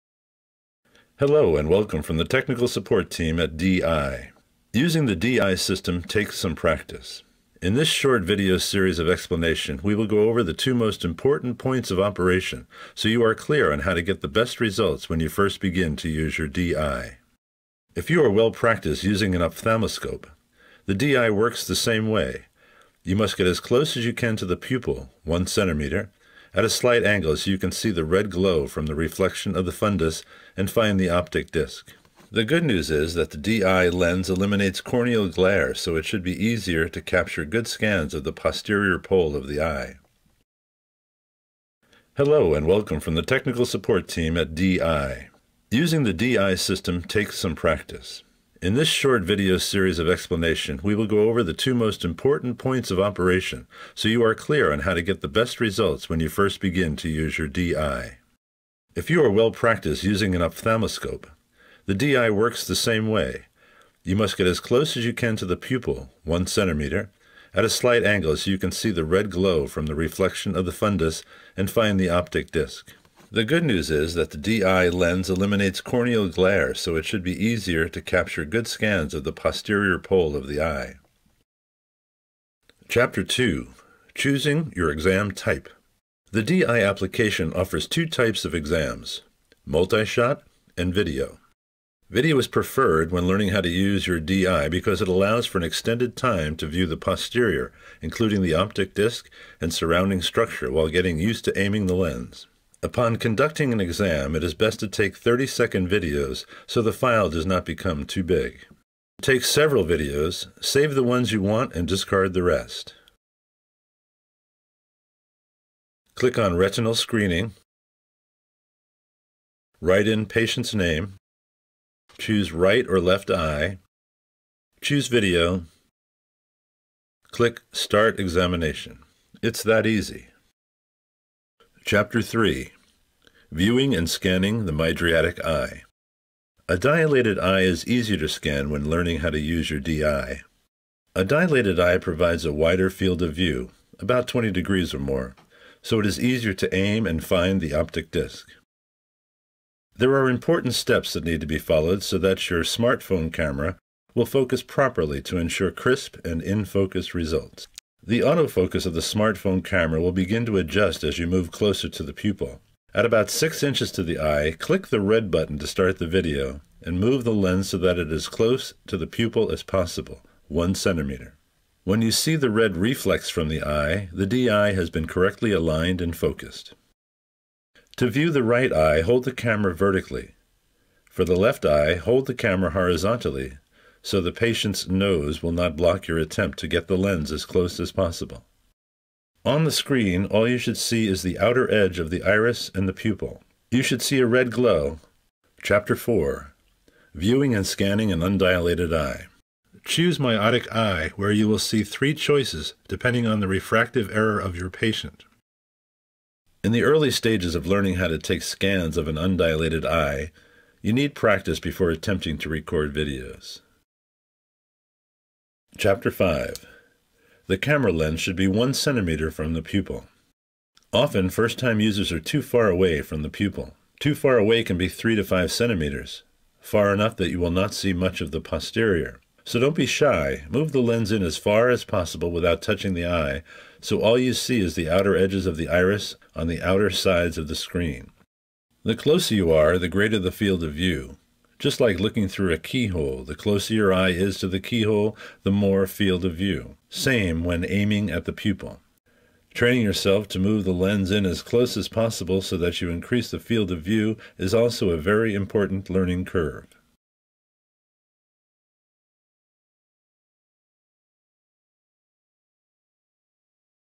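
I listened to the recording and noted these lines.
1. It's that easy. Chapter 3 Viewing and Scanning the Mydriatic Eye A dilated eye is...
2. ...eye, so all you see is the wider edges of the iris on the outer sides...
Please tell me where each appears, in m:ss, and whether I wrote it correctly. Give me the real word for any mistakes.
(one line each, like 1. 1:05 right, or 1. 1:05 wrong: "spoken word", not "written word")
1. 2:09 right
2. 3:53 wrong: "outer", not "wider".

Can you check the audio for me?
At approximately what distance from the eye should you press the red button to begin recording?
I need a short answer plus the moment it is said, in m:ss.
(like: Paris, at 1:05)
6 inches, at 2:43.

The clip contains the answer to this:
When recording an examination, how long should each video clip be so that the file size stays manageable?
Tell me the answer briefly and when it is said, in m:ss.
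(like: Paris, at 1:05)
30 seconds, at 1:45.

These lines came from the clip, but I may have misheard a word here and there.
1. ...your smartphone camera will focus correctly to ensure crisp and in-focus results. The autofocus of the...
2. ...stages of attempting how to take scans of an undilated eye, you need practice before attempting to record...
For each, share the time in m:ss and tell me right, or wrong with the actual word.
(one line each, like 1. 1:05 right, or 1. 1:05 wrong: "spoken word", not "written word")
1. 2:32 wrong: "properly", not "correctly"
2. 3:27 wrong: "learning", not "attempting".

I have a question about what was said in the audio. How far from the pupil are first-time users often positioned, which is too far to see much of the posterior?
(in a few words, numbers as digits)
3 to 5 centimeters.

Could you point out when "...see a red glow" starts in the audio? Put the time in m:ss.
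3:14.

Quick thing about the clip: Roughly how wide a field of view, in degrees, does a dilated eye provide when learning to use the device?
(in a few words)
20 degrees.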